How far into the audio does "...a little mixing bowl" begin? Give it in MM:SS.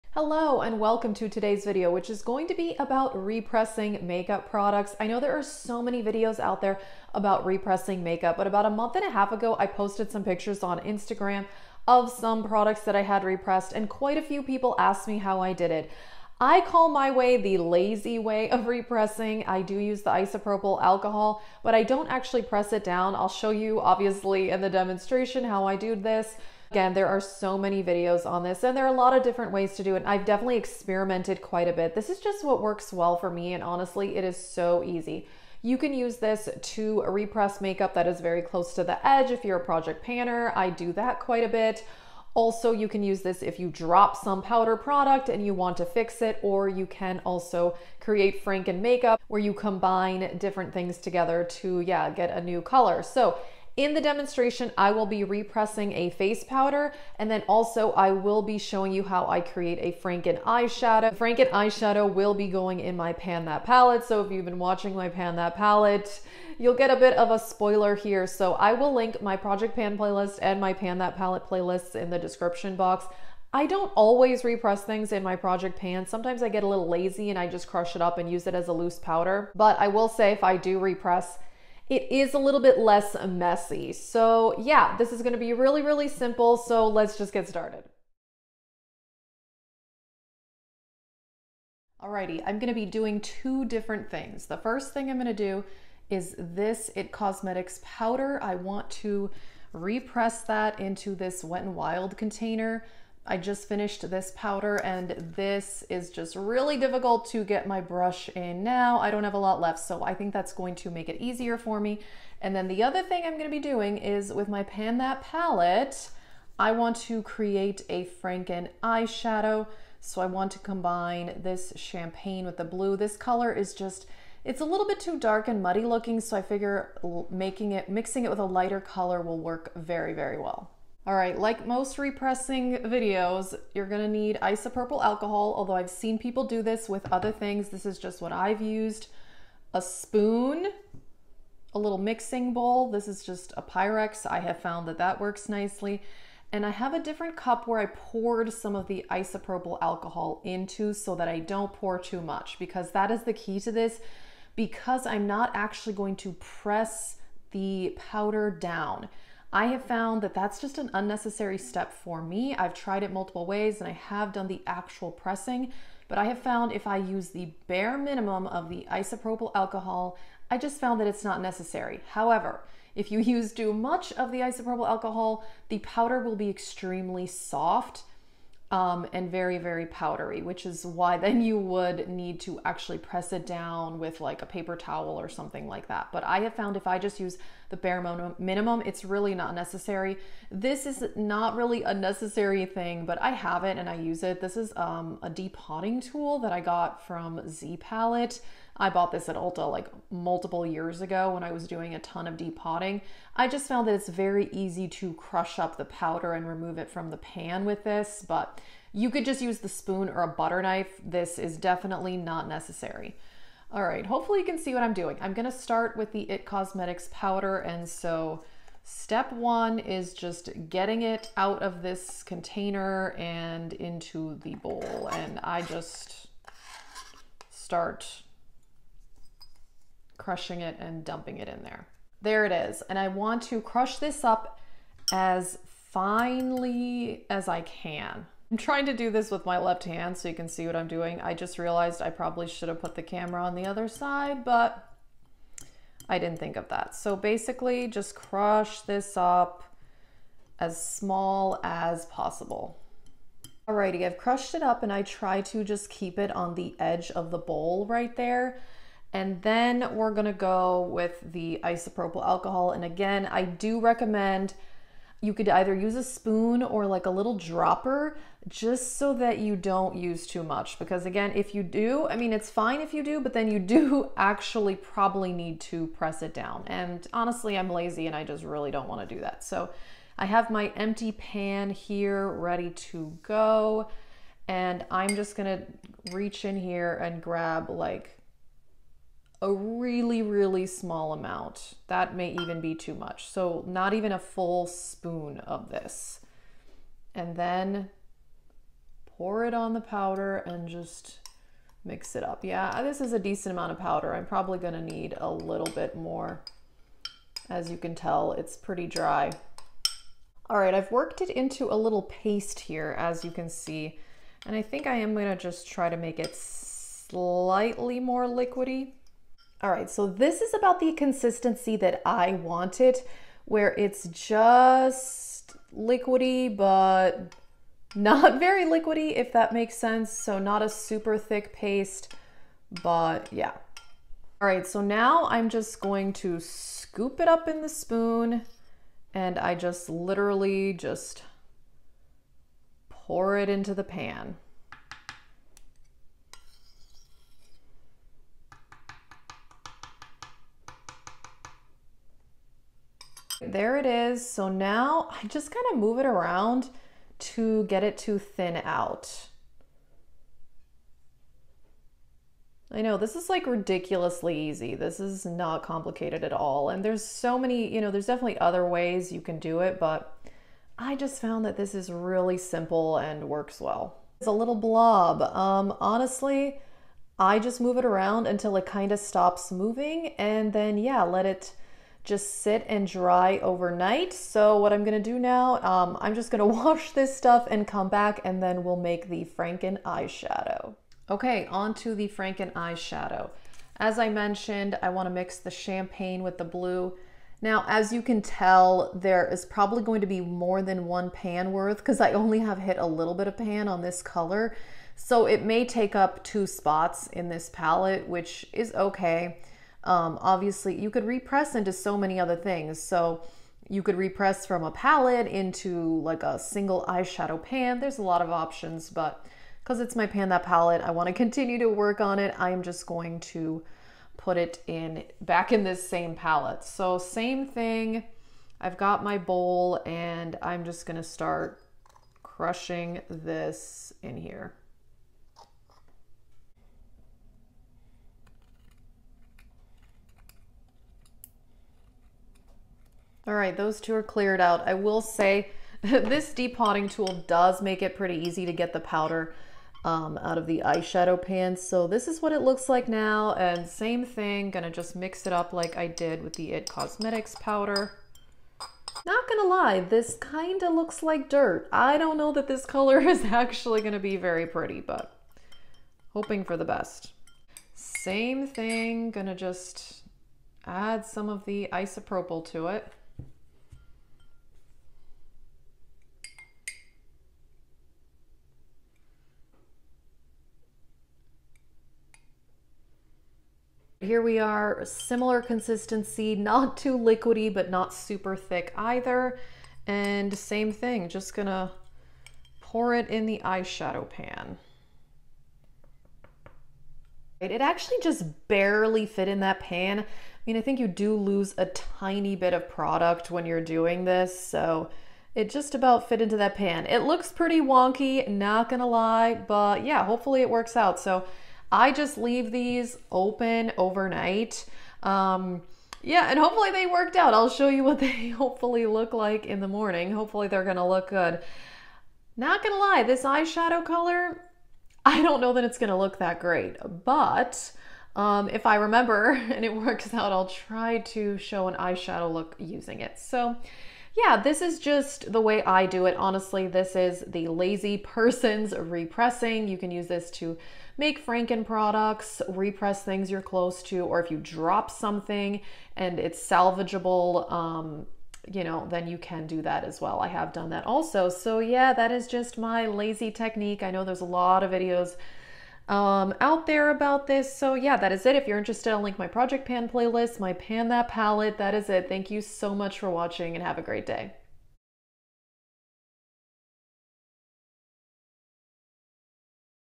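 02:21.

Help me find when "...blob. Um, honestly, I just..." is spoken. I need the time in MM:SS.
06:14.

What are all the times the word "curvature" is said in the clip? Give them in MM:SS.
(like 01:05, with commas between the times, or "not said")
not said.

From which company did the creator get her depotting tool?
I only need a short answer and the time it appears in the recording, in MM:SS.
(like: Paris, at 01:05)
Z Palette, at 03:17.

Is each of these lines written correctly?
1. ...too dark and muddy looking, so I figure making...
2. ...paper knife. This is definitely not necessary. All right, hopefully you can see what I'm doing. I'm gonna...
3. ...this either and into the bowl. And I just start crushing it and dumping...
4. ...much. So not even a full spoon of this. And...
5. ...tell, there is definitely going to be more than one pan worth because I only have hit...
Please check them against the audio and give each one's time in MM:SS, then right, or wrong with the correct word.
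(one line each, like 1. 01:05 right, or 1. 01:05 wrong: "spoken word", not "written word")
1. 02:04 right
2. 03:30 wrong: "butter", not "paper"
3. 03:41 wrong: "container", not "either"
4. 04:52 right
5. 06:38 wrong: "probably", not "definitely".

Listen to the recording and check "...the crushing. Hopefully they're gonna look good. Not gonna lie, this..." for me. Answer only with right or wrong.
wrong.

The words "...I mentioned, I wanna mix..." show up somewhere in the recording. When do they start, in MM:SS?
06:33.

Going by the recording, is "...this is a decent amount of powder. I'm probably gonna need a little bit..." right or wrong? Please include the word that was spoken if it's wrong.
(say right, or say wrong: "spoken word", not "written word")
right.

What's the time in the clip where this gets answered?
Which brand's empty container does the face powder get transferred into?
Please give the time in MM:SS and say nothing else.
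01:41.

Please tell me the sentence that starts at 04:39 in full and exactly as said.
So I have my empty pan here ready to go.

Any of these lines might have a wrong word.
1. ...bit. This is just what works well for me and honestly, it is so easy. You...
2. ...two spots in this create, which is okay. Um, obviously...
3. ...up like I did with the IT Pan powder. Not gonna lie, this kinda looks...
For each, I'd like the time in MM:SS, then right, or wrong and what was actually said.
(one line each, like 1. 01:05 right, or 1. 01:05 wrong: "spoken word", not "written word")
1. 00:31 right
2. 06:46 wrong: "palette", not "create"
3. 07:35 wrong: "Cosmetics", not "Pan".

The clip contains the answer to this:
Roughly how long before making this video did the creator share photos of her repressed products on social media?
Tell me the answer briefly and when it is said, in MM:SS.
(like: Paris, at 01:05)
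a month and a half, at 00:08.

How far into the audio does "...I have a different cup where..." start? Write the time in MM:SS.
02:26.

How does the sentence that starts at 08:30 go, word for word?
So I just leave these open overnight.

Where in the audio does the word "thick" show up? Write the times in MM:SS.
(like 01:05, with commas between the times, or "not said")
05:31, 08:08.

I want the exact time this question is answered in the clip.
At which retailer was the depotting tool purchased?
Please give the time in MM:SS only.
03:19.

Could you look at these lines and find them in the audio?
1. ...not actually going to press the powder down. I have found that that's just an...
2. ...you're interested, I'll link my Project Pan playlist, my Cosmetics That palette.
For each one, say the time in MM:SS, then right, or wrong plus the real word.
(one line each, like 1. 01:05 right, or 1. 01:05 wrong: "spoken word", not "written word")
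1. 02:35 right
2. 09:18 wrong: "Pan", not "Cosmetics".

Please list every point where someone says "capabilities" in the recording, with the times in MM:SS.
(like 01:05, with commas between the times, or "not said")
not said.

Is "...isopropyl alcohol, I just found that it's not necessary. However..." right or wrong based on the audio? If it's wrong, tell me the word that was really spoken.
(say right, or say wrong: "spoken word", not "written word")
right.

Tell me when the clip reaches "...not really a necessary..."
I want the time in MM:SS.
03:11.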